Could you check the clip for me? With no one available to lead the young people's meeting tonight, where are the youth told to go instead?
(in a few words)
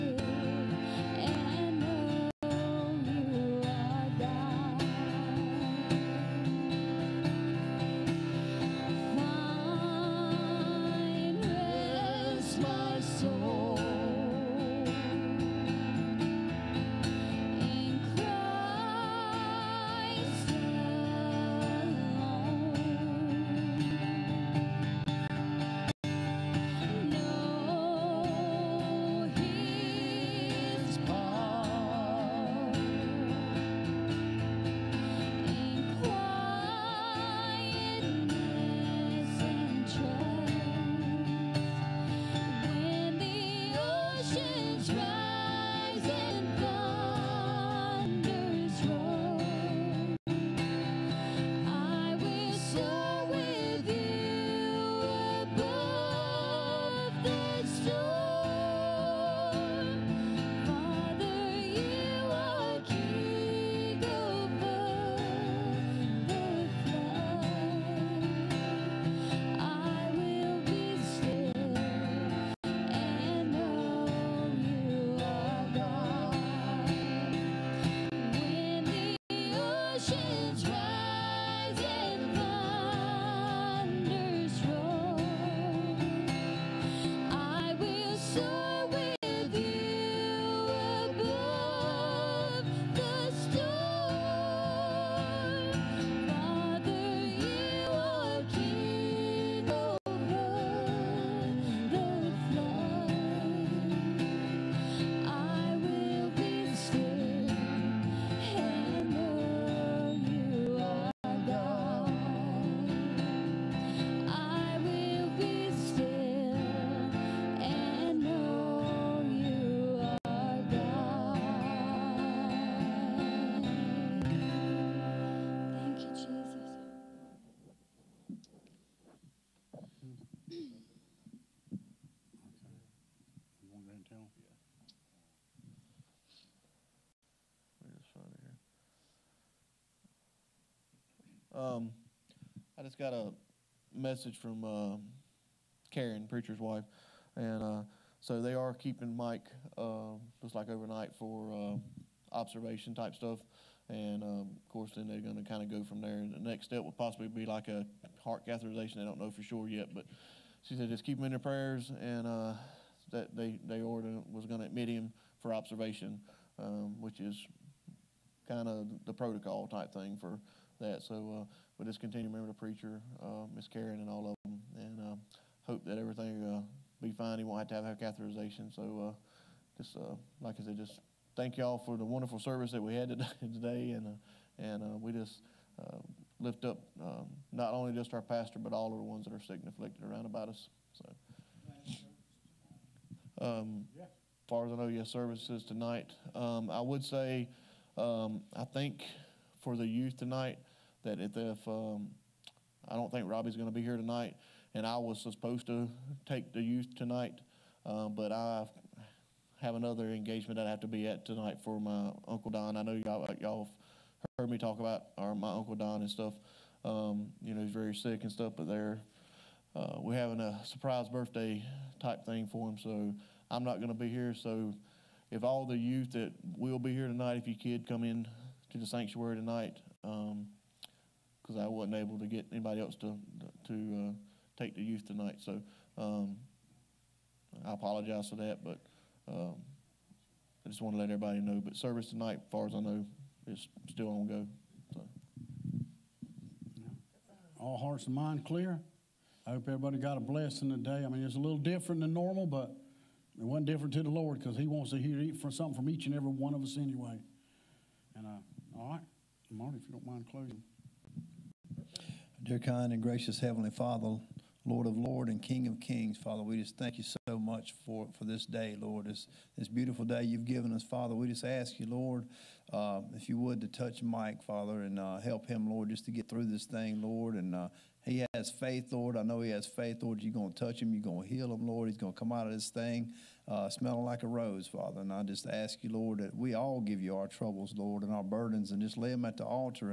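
the sanctuary.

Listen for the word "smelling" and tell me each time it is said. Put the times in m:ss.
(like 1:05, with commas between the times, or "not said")
4:43.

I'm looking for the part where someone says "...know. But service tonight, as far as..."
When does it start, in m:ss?
4:01.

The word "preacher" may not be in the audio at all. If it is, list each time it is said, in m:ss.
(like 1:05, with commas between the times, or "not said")
2:26, 2:52.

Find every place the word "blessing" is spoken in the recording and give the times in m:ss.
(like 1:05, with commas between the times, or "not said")
4:10.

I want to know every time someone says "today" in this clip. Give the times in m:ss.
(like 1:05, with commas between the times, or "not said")
3:03, 4:10.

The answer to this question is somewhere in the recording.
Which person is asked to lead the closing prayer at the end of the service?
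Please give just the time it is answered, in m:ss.
4:19.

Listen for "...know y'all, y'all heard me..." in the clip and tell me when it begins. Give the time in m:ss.
3:32.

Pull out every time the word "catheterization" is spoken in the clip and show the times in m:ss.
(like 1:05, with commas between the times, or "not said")
2:38, 2:57.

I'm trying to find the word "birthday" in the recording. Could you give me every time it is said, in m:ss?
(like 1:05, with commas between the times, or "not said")
3:41.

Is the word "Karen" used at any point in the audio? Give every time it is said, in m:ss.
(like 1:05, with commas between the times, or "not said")
2:25, 2:53.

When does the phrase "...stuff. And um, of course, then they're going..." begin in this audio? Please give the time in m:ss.
2:33.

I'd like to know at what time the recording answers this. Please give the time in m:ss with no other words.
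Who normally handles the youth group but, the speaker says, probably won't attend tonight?
3:23.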